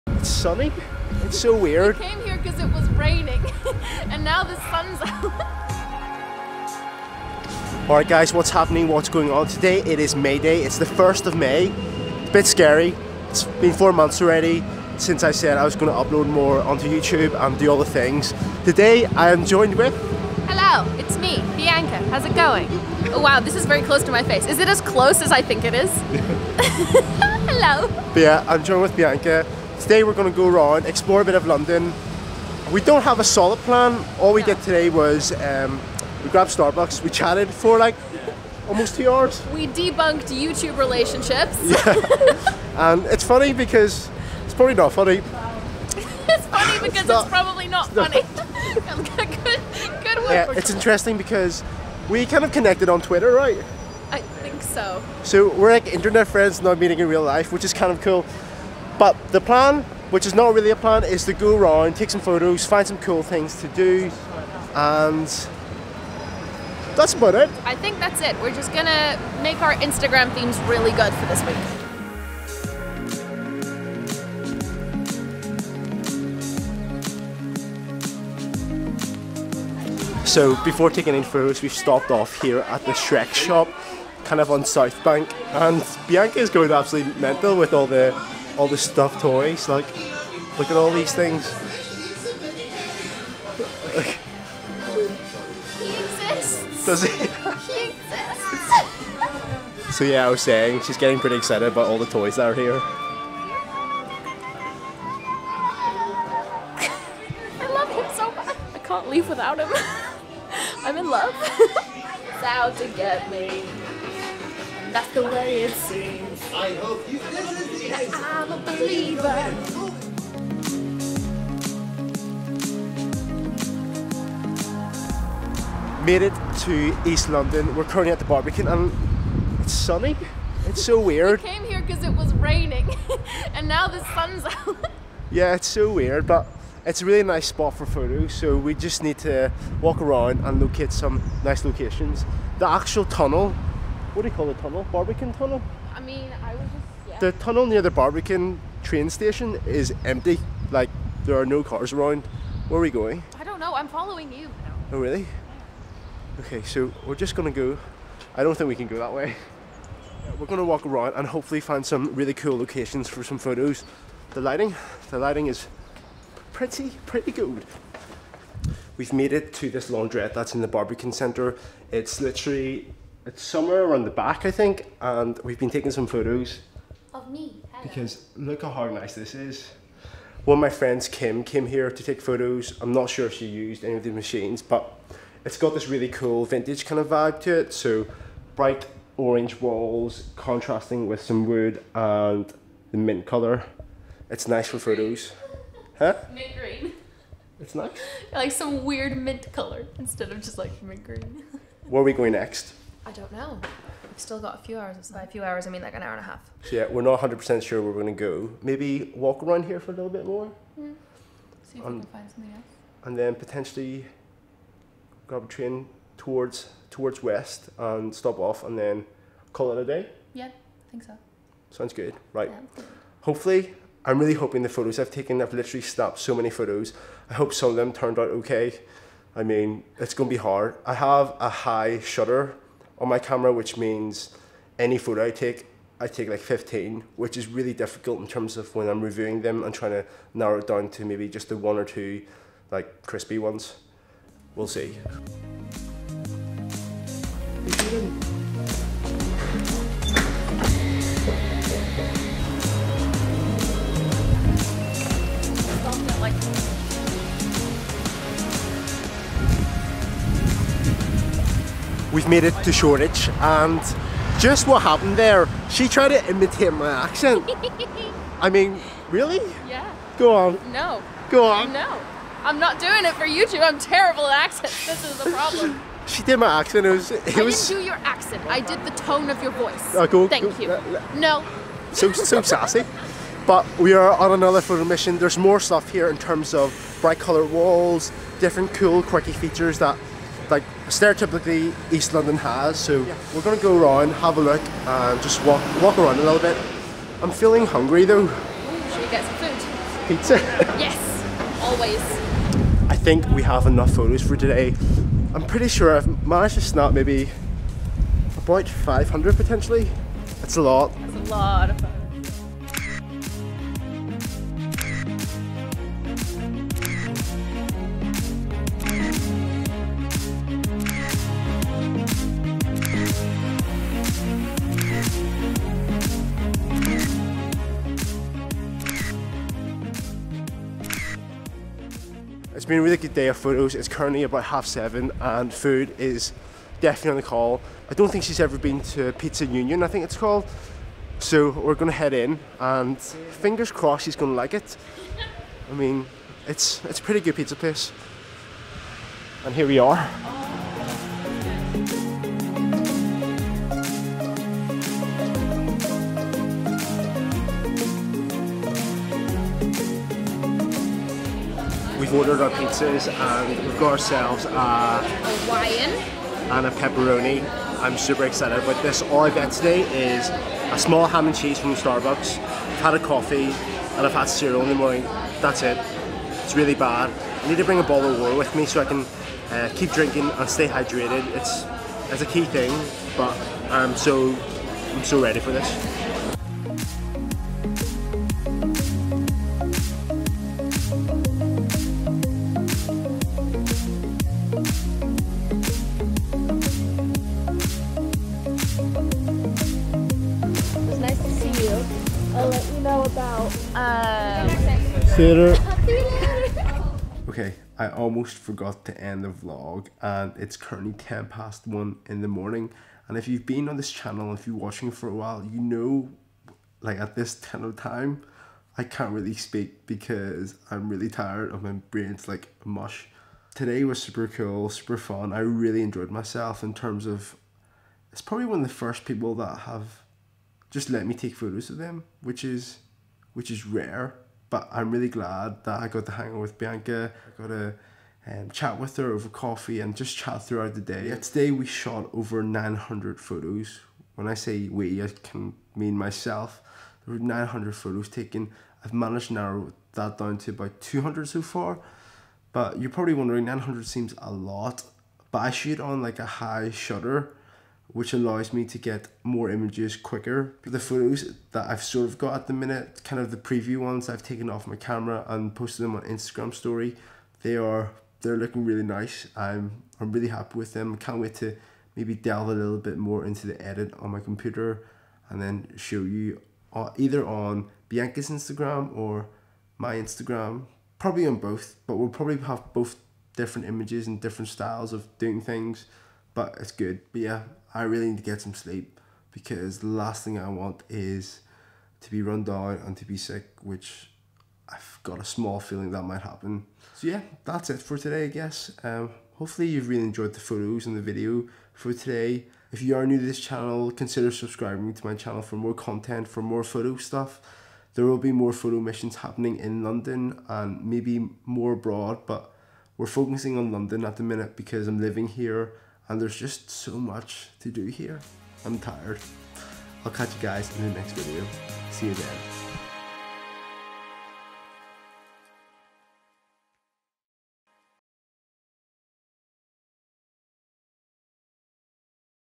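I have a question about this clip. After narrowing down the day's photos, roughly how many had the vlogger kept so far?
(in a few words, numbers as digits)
200.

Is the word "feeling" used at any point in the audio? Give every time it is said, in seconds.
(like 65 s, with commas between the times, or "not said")
297 s, 495 s.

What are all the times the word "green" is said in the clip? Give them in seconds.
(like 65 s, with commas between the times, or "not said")
196 s, 201 s.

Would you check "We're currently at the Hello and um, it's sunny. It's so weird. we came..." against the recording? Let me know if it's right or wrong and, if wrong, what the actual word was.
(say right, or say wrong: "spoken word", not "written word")
wrong: "Barbican", not "Hello".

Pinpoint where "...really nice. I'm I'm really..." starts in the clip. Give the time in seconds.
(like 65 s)
468 s.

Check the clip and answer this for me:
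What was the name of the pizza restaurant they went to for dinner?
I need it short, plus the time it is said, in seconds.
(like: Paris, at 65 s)
Pizza Union, at 339 s.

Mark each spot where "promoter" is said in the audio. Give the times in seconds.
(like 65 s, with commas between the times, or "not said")
not said.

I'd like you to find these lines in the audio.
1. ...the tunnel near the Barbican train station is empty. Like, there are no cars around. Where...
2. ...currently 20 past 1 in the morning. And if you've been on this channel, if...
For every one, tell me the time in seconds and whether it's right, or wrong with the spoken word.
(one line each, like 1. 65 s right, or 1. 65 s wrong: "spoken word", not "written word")
1. 147 s right
2. 410 s wrong: "10", not "20".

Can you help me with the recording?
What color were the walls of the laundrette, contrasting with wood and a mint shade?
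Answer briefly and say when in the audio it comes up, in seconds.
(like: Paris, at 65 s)
Bright orange, at 188 s.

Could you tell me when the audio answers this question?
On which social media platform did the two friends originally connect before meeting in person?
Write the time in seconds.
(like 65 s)
53 s.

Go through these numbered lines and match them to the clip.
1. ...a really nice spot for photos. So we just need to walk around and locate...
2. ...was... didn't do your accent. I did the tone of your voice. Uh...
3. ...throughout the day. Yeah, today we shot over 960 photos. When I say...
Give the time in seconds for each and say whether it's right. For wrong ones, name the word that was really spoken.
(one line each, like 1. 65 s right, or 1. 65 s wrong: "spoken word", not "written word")
1. 137 s right
2. 277 s right
3. 440 s wrong: "900", not "960".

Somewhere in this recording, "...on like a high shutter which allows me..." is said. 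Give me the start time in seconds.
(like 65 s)
455 s.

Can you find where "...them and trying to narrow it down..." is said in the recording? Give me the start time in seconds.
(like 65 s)
239 s.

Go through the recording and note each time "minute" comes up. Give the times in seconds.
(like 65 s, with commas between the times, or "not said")
462 s, 514 s.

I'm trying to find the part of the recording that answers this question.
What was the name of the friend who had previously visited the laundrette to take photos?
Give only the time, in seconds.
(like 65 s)
181 s.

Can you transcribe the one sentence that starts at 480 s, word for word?
Probably on both, but we'll probably have both different images and different styles of doing things but it's good.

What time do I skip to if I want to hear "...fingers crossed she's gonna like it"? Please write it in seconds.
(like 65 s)
342 s.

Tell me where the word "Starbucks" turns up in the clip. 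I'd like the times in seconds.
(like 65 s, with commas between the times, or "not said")
36 s, 371 s.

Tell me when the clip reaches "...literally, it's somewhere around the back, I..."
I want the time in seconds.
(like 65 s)
172 s.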